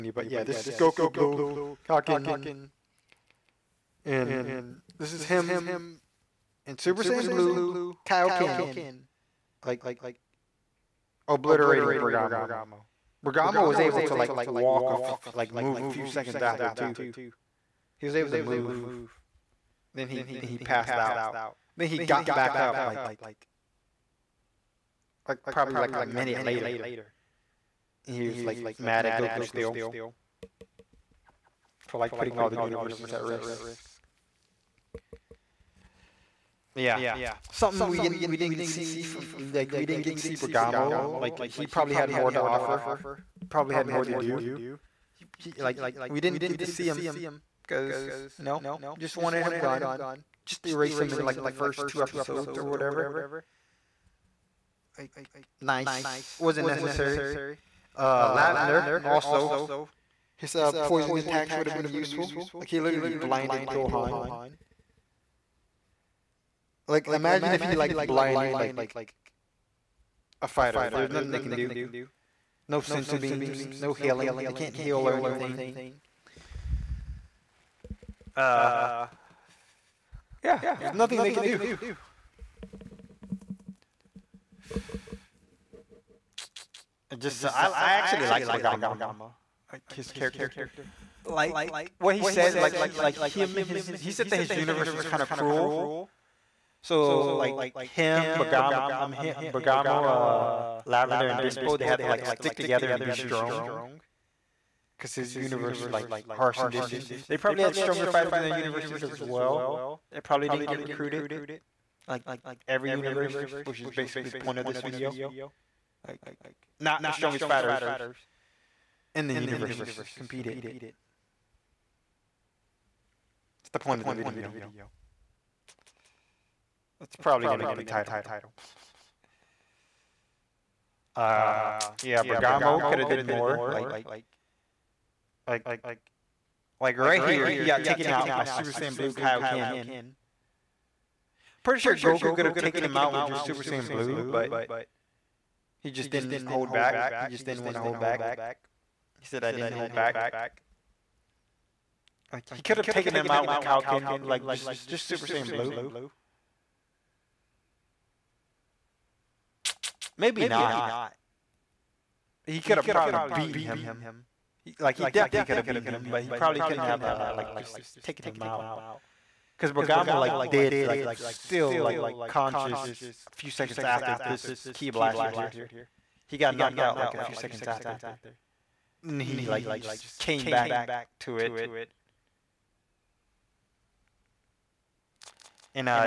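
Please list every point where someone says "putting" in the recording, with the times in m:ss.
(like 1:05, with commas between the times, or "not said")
0:32.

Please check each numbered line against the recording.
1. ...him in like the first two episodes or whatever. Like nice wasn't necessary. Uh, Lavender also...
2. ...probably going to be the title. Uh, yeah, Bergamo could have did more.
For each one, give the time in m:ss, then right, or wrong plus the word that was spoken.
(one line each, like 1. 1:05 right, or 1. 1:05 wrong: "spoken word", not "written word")
1. 0:50 right
2. 2:07 right.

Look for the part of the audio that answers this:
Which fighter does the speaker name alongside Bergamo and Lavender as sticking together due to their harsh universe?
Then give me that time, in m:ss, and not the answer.
1:41.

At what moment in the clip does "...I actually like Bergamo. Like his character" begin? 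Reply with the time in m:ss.
1:27.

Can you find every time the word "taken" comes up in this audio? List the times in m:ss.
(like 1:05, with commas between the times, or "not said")
2:17, 2:22, 2:32, 2:48.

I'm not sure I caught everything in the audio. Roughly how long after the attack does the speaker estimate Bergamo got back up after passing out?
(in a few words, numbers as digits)
a minute.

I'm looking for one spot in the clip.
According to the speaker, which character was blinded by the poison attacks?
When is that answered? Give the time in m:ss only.
1:03.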